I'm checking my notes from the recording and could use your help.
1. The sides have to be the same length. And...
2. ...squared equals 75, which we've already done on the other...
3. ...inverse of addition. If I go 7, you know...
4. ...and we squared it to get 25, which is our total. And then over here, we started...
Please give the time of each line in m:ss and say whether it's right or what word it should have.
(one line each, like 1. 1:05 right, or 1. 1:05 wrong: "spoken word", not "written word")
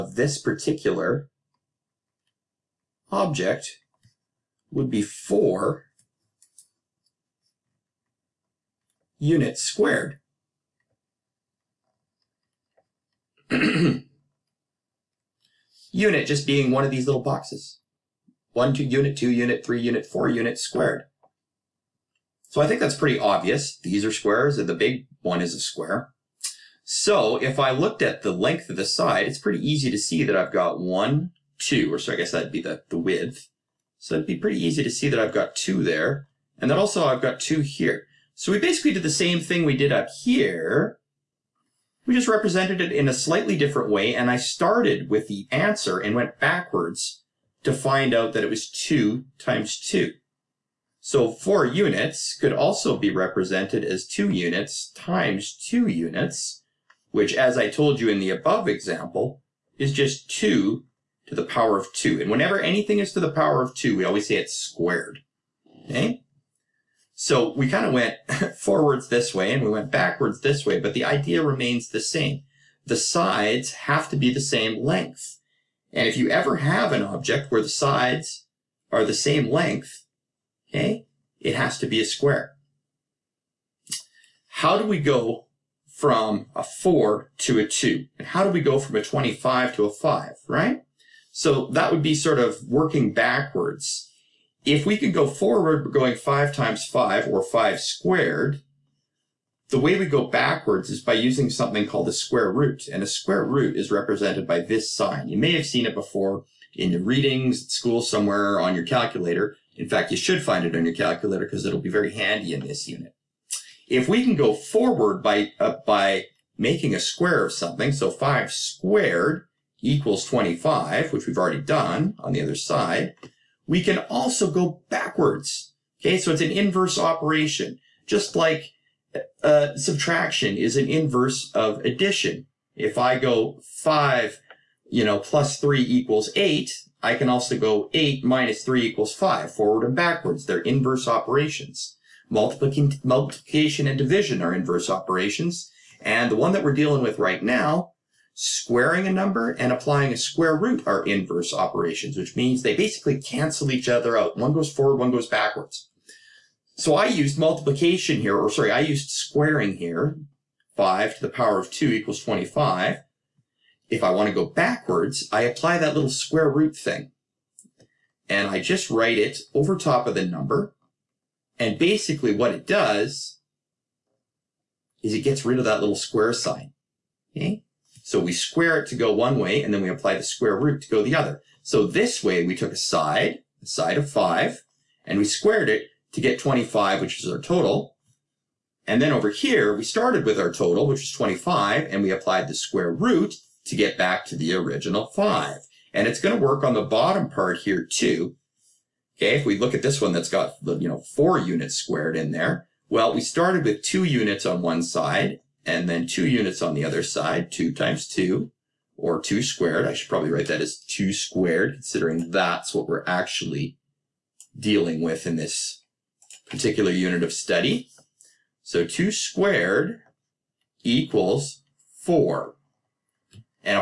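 1. 1:12 right
2. 1:58 wrong: "25", not "75"
3. 2:10 wrong: "5", not "7"
4. 3:05 right.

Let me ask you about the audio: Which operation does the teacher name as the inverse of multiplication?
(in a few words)
division.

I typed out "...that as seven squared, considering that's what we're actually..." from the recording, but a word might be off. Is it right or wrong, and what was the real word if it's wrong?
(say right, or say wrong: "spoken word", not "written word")
wrong: "two", not "seven".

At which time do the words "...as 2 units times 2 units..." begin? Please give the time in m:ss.
0:53.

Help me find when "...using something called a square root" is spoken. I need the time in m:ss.
1:41.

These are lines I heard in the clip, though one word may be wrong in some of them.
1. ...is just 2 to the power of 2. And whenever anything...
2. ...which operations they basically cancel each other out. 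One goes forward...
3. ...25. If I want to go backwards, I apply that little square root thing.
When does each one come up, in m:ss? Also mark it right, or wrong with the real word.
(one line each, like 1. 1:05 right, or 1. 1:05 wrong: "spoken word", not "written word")
1. 0:59 right
2. 2:32 wrong: "means", not "operations"
3. 2:42 right.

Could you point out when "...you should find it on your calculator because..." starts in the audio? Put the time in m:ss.
1:50.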